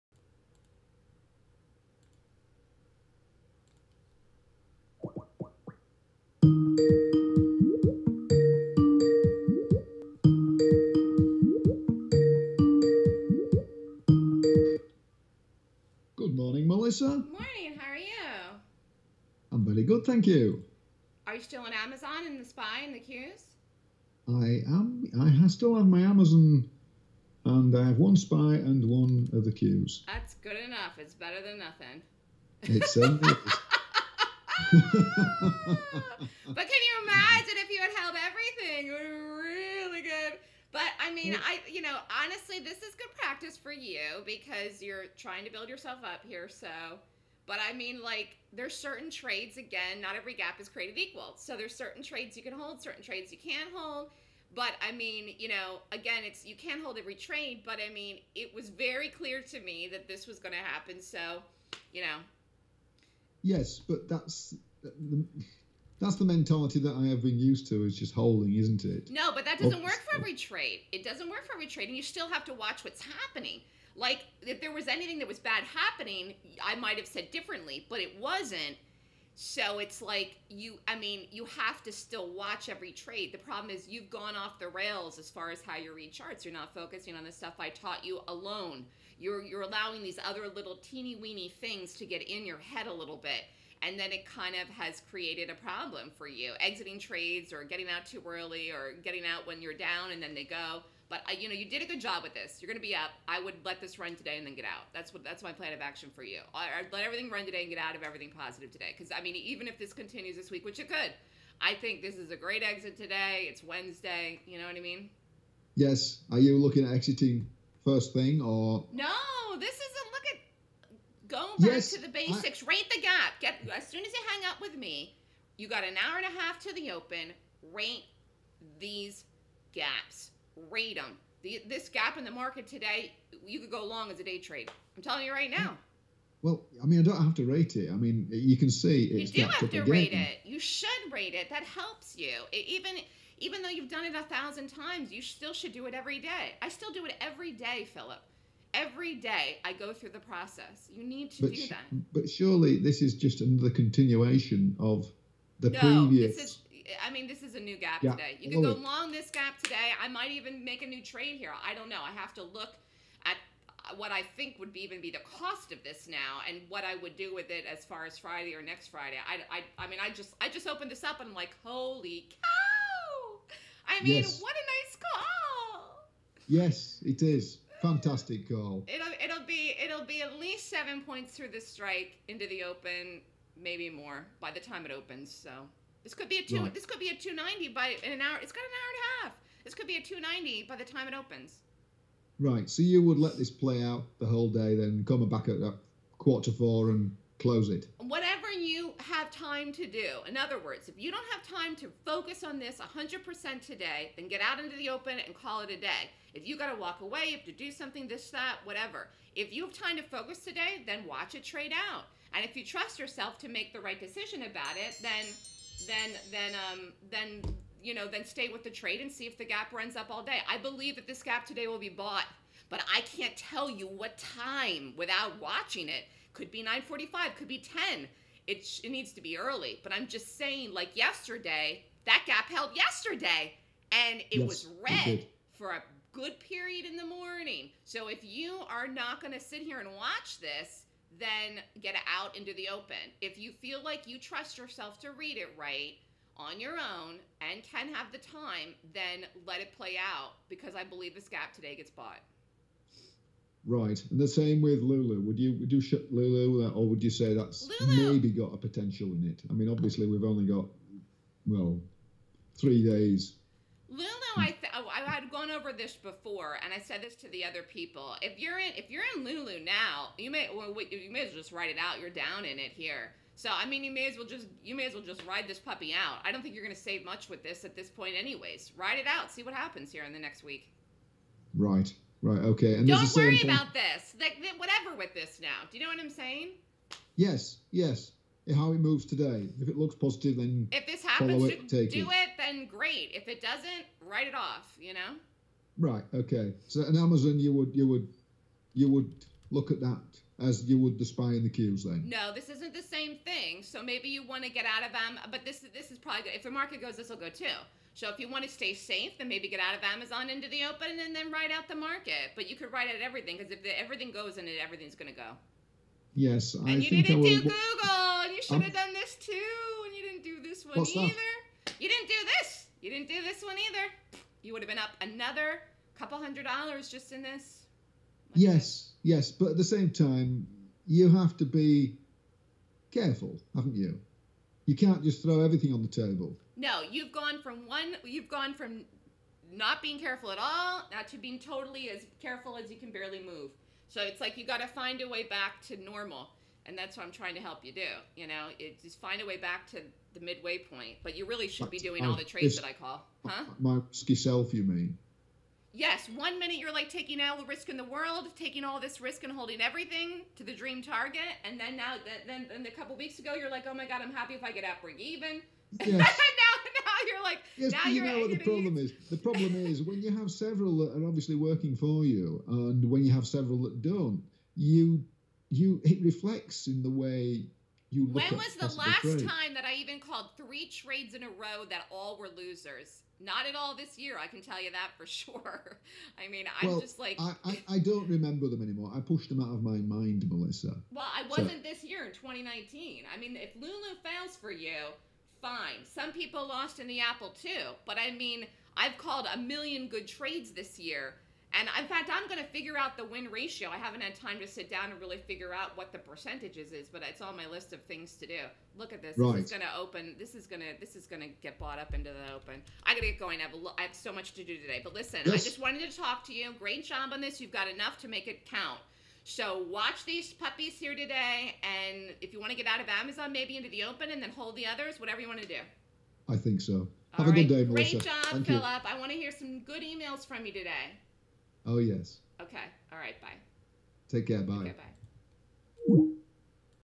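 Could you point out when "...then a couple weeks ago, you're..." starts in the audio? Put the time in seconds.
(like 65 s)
362 s.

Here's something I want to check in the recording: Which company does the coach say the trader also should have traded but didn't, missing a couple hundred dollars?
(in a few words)
Google.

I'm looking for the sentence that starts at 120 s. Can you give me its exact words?
Look at going back yes, to the basics.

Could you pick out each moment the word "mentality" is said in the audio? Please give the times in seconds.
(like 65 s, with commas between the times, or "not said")
66 s.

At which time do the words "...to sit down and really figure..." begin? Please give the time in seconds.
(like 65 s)
404 s.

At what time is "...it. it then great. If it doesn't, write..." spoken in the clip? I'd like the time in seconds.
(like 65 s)
291 s.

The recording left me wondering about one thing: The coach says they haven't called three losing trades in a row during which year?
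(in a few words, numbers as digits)
2019.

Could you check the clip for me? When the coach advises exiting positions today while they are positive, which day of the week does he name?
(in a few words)
Wednesday.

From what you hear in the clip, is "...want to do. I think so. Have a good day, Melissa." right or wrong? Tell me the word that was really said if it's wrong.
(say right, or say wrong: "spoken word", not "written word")
right.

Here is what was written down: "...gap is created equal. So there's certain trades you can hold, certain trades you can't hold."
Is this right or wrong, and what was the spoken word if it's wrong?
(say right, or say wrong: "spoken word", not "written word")
right.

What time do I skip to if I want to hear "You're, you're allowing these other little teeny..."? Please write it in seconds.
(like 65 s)
89 s.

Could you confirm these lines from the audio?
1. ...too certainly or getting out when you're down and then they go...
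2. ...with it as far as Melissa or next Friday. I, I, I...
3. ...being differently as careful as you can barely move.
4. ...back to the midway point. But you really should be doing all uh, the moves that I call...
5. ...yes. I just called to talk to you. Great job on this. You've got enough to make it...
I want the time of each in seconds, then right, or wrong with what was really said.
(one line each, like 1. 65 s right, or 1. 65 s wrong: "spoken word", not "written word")
1. 98 s wrong: "early", not "certainly"
2. 167 s wrong: "Friday", not "Melissa"
3. 341 s wrong: "totally", not "differently"
4. 349 s wrong: "trades", not "moves"
5. 415 s wrong: "wanted", not "called".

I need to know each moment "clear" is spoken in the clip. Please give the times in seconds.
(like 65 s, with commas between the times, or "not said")
59 s.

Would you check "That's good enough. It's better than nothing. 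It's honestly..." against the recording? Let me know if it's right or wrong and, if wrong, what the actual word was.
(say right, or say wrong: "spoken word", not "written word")
wrong: "certainly", not "honestly".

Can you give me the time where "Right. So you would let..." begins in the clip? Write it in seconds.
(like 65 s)
192 s.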